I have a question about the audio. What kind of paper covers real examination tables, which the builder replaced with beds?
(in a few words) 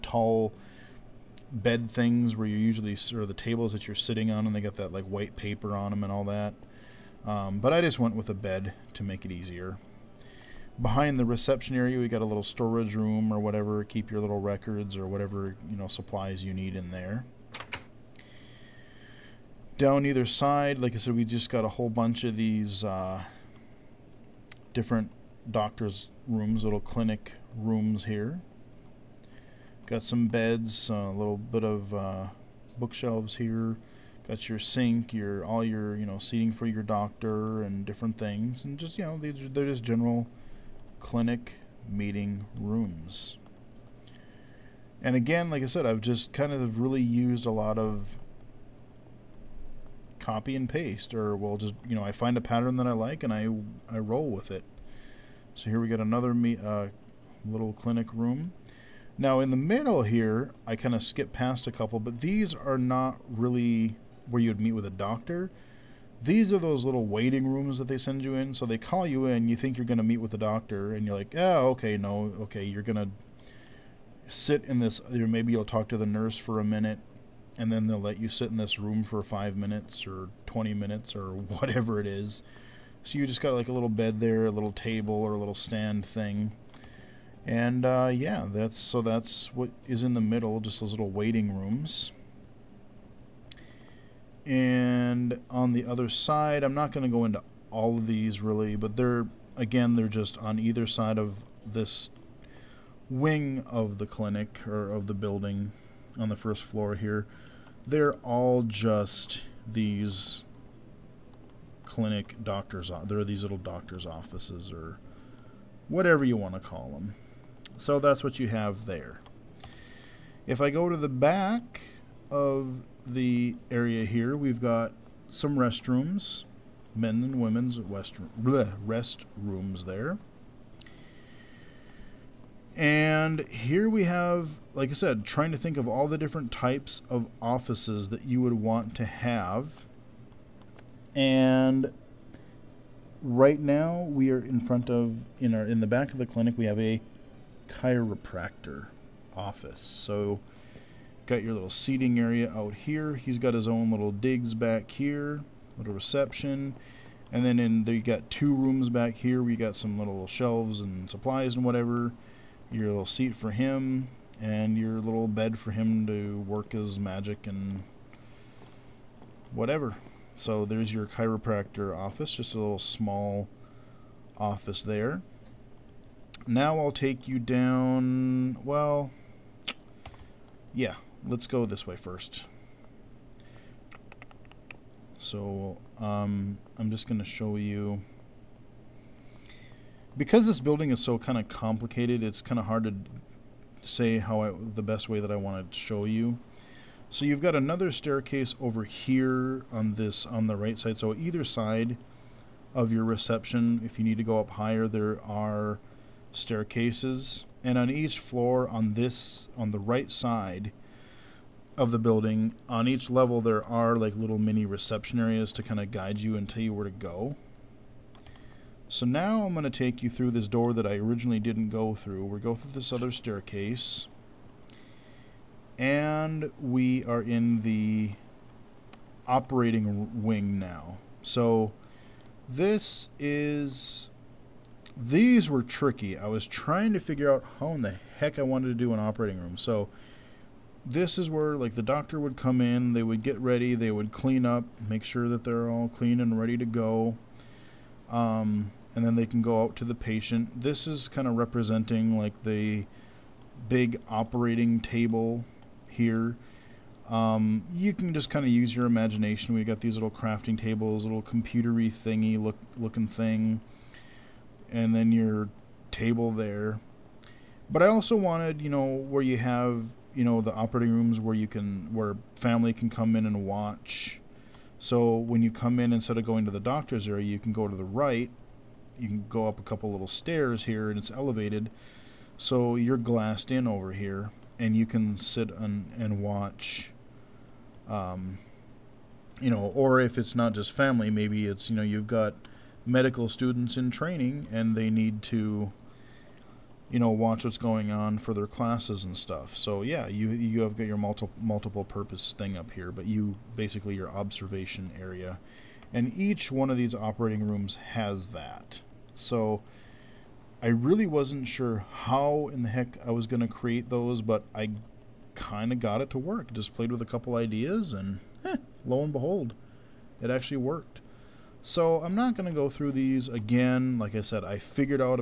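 White paper.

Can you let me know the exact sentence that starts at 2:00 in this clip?
If I go to the back of the area here, we've got some restrooms, men and women's rest, rooms there.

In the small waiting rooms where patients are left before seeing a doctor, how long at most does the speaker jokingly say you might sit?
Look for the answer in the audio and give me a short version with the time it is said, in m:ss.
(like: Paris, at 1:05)
20 minutes, at 1:20.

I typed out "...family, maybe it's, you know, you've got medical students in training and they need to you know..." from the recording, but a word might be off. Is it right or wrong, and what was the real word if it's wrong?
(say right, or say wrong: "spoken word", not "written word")
right.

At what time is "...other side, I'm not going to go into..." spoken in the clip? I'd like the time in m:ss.
1:35.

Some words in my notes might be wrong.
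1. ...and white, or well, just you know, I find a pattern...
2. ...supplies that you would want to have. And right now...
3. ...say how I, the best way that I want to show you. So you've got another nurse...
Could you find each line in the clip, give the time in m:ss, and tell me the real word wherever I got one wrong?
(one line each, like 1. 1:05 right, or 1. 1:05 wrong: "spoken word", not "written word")
1. 0:50 wrong: "paste", not "white"
2. 2:17 wrong: "offices", not "supplies"
3. 3:13 wrong: "staircase", not "nurse".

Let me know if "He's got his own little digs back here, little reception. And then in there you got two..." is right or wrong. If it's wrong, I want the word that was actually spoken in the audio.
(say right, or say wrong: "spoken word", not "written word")
right.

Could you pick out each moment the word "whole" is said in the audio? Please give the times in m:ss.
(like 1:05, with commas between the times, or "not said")
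0:21.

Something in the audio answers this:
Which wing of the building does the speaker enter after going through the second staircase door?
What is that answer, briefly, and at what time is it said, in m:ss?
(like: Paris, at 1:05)
Operating wing, at 3:49.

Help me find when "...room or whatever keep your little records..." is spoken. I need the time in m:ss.
0:12.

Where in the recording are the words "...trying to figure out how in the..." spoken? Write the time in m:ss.
3:56.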